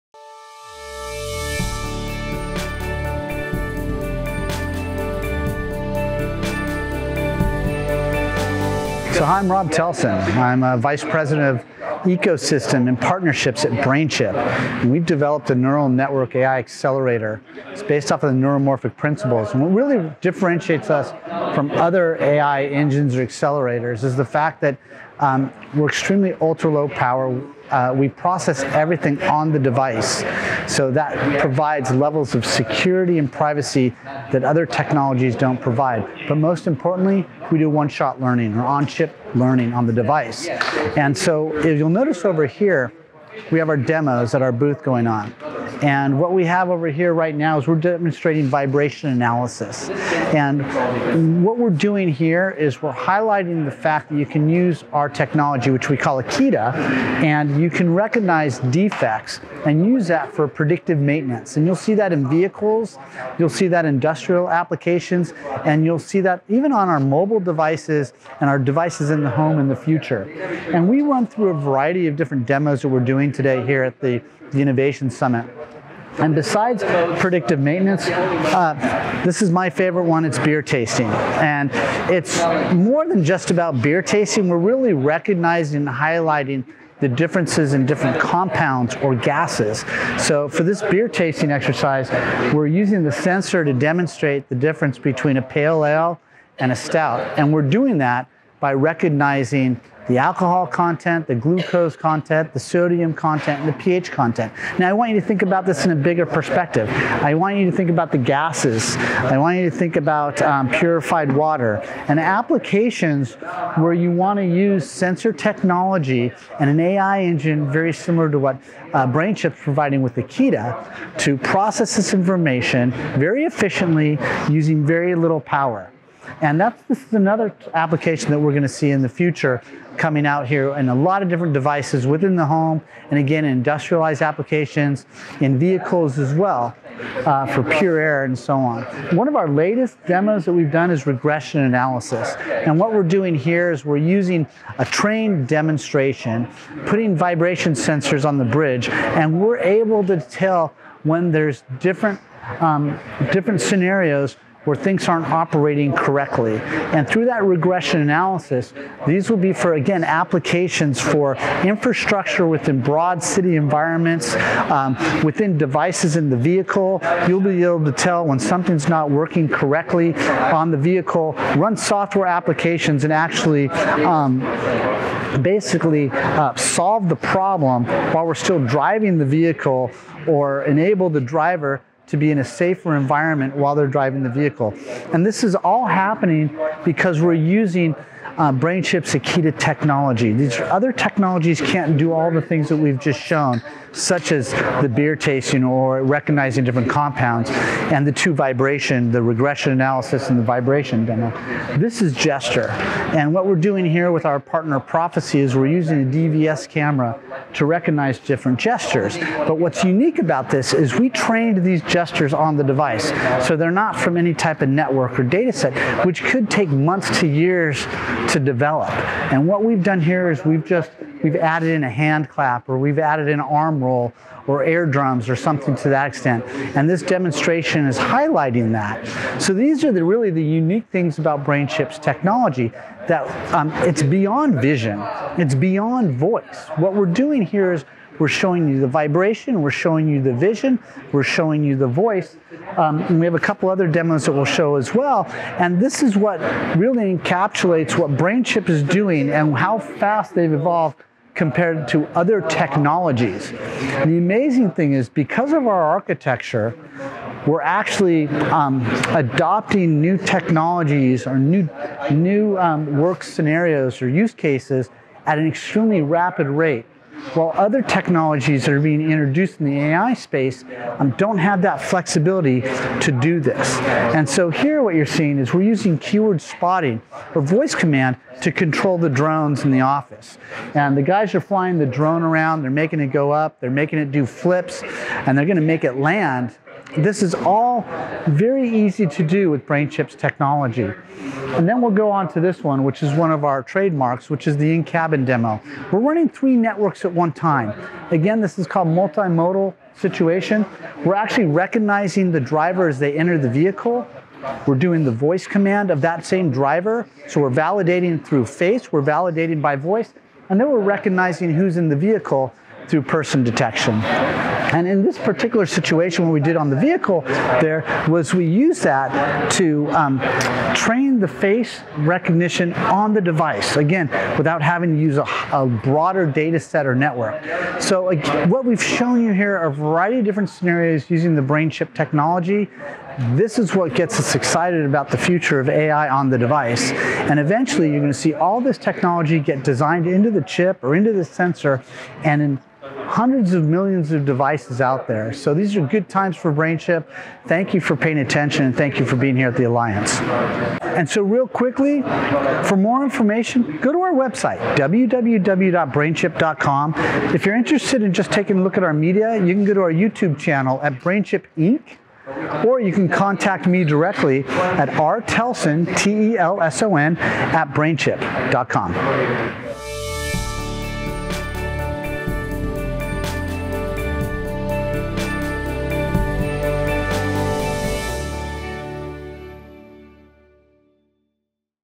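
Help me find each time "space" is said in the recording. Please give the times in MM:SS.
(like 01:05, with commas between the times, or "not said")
04:30.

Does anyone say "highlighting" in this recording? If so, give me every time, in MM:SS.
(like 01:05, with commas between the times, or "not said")
00:52, 01:25, 03:47.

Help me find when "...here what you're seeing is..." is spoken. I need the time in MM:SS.
04:34.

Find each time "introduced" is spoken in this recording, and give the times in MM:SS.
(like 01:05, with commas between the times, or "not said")
04:29.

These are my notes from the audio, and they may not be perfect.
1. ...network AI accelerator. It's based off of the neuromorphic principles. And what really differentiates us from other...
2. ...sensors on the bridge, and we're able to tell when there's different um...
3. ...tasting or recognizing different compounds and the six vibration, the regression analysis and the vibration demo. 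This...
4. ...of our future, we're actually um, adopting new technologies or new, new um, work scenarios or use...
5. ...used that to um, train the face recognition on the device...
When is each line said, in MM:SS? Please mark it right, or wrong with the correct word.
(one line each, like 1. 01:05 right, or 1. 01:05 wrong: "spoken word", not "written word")
1. 00:15 right
2. 02:27 right
3. 03:15 wrong: "two", not "six"
4. 04:15 wrong: "architecture", not "future"
5. 05:18 right.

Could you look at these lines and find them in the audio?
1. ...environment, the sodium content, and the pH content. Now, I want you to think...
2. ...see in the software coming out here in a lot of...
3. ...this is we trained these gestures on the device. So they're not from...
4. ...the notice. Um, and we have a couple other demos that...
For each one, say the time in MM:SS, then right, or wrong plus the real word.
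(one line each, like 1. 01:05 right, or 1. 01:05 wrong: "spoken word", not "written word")
1. 01:41 wrong: "content", not "environment"
2. 02:08 wrong: "future", not "software"
3. 03:30 right
4. 04:01 wrong: "voice", not "notice".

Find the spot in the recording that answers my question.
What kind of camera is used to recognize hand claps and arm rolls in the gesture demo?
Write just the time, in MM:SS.
03:26.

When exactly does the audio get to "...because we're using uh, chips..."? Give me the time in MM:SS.
03:06.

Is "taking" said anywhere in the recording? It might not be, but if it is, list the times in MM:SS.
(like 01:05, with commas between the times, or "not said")
05:58.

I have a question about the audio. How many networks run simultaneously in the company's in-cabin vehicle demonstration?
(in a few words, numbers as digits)
3.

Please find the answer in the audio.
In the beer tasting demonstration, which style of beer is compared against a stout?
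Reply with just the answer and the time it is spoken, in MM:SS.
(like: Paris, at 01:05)
pale ale, at 01:35.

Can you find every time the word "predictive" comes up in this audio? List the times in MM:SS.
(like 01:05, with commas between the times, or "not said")
01:00, 01:17.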